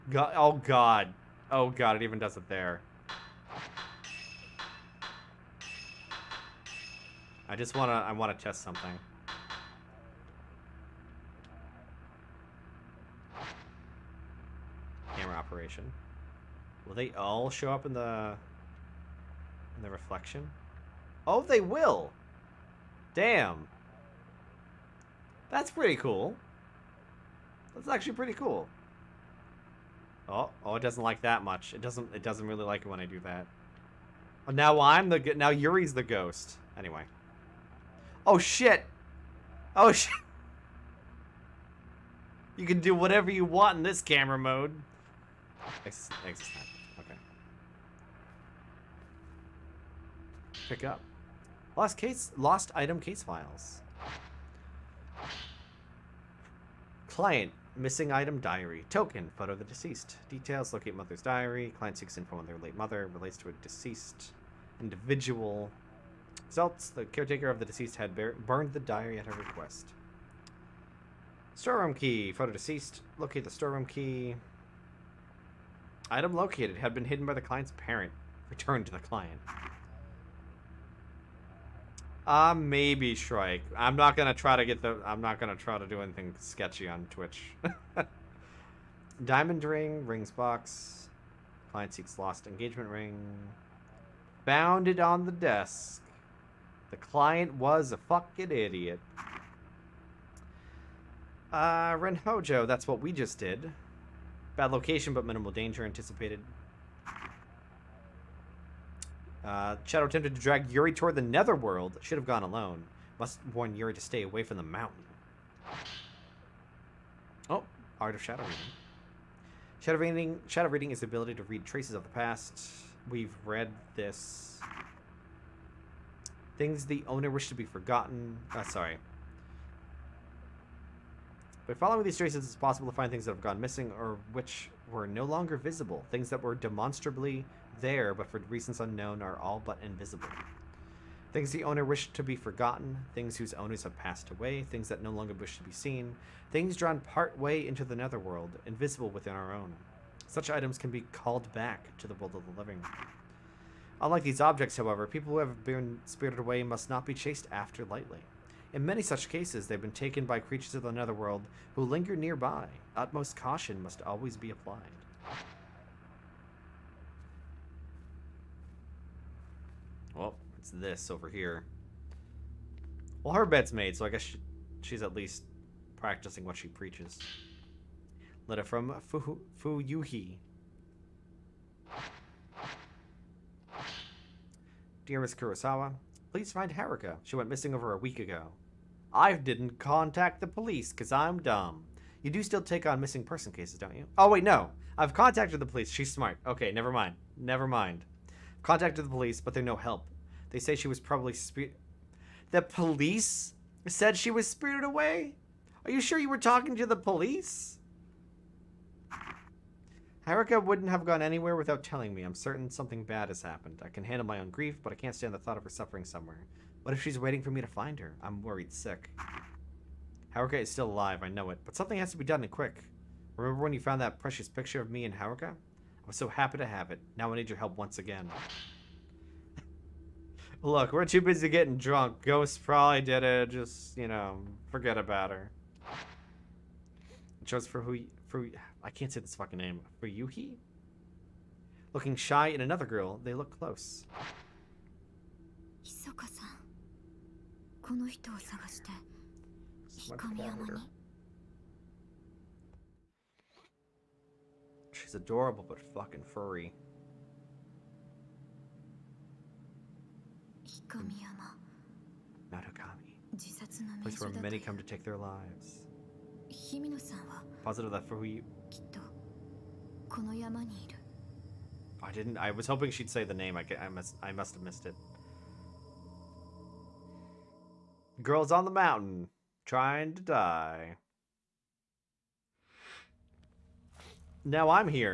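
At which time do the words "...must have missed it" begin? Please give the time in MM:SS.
04:34.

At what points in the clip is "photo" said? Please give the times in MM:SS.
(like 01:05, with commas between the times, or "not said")
00:59, 01:12.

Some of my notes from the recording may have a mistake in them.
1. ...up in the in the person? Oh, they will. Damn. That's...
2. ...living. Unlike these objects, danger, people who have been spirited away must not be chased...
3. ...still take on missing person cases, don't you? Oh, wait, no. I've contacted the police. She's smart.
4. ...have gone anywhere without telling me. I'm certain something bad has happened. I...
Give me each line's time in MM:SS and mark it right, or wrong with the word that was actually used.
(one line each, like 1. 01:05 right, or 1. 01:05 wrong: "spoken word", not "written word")
1. 00:17 wrong: "reflection", not "person"
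2. 02:32 wrong: "however", not "danger"
3. 03:12 right
4. 03:30 right.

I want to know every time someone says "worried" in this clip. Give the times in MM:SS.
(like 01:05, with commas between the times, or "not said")
03:38.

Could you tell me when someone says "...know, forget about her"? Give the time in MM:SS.
03:54.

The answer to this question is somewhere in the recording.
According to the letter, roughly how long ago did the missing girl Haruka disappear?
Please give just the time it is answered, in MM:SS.
03:07.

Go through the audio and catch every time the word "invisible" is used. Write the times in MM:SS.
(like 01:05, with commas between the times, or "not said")
02:19, 02:28.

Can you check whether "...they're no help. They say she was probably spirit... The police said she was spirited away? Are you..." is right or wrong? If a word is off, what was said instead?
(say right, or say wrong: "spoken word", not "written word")
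right.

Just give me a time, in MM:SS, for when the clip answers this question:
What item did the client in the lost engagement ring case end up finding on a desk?
01:29.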